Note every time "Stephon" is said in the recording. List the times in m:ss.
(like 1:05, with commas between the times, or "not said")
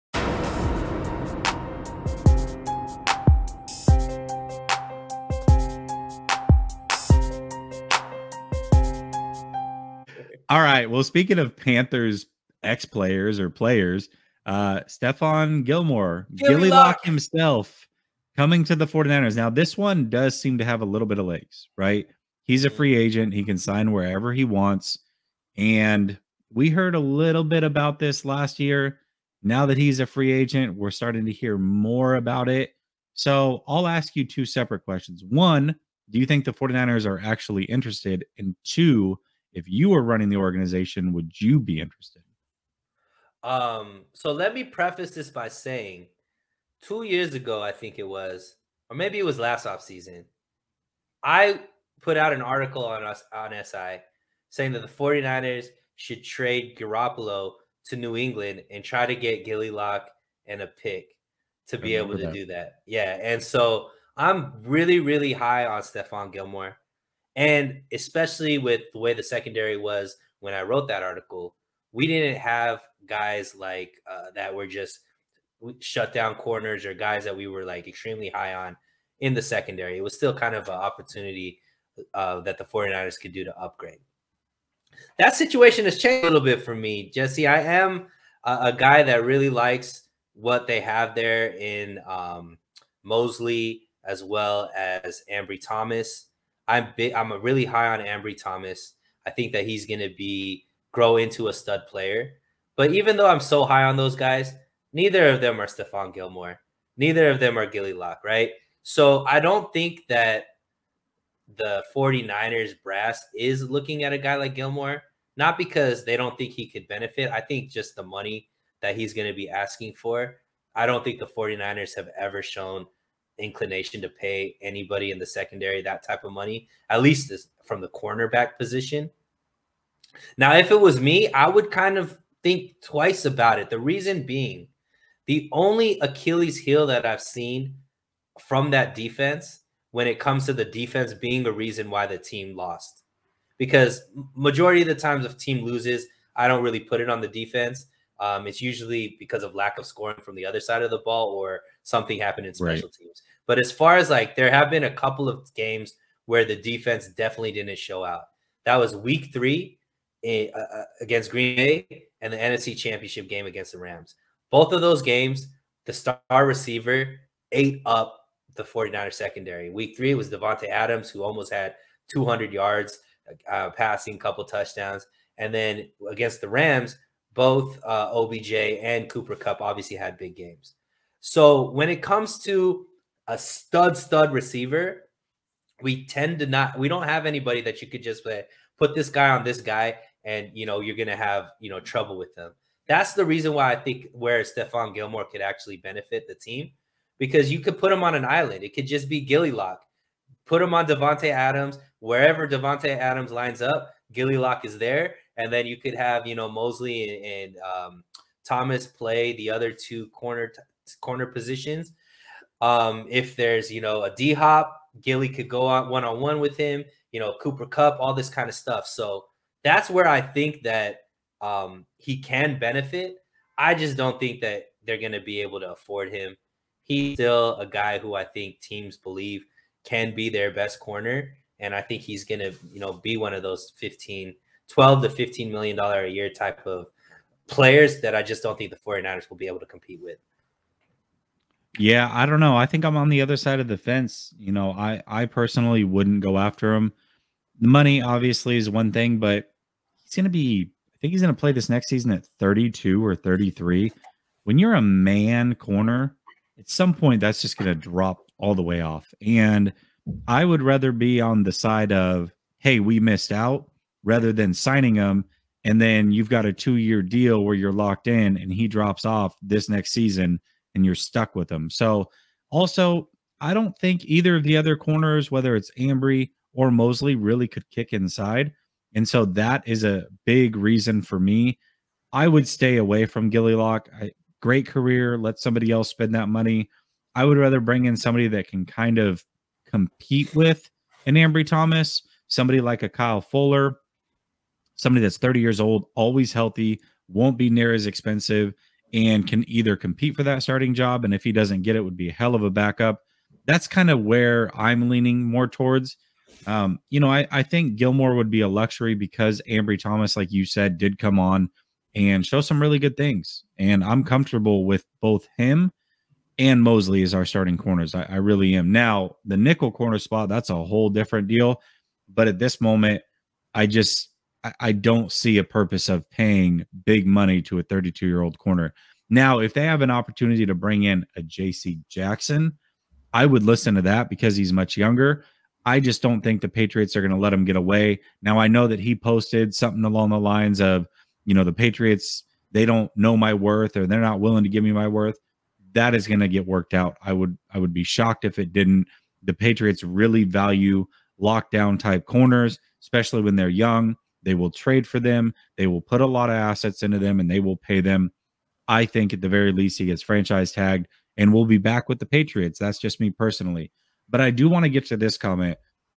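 0:14, 1:05, 1:45, 3:14.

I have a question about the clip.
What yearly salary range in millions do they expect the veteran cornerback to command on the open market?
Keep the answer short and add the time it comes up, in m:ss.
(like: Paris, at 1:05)
12 to 15 million, at 3:54.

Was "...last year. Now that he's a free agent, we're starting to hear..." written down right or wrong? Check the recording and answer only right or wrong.
right.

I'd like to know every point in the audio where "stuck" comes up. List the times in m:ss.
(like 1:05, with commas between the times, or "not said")
4:30.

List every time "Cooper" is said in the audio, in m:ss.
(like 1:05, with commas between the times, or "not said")
2:59, 3:37.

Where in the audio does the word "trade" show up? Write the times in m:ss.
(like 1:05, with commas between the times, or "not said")
0:56, 5:54.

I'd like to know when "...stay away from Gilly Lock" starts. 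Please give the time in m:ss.
4:42.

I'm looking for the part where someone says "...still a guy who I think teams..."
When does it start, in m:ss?
3:47.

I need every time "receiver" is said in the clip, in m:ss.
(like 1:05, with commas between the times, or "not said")
2:46, 3:04.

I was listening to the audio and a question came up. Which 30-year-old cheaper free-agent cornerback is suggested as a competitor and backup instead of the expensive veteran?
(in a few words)
Kyle Fuller.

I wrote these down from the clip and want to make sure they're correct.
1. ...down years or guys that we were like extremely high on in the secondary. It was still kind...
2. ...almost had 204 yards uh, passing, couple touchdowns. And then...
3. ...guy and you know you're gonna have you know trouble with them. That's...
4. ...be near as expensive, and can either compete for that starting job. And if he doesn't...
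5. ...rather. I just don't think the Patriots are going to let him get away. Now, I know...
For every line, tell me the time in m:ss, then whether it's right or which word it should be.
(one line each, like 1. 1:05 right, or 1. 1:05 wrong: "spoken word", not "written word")
1. 1:16 wrong: "corners", not "years"
2. 2:51 wrong: "200", not "204"
3. 3:09 right
4. 4:57 right
5. 5:34 wrong: "younger", not "rather".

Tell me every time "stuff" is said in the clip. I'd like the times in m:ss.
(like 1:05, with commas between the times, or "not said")
3:38.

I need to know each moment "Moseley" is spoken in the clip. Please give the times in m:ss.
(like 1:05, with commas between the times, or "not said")
1:33, 3:26, 4:36, 5:16.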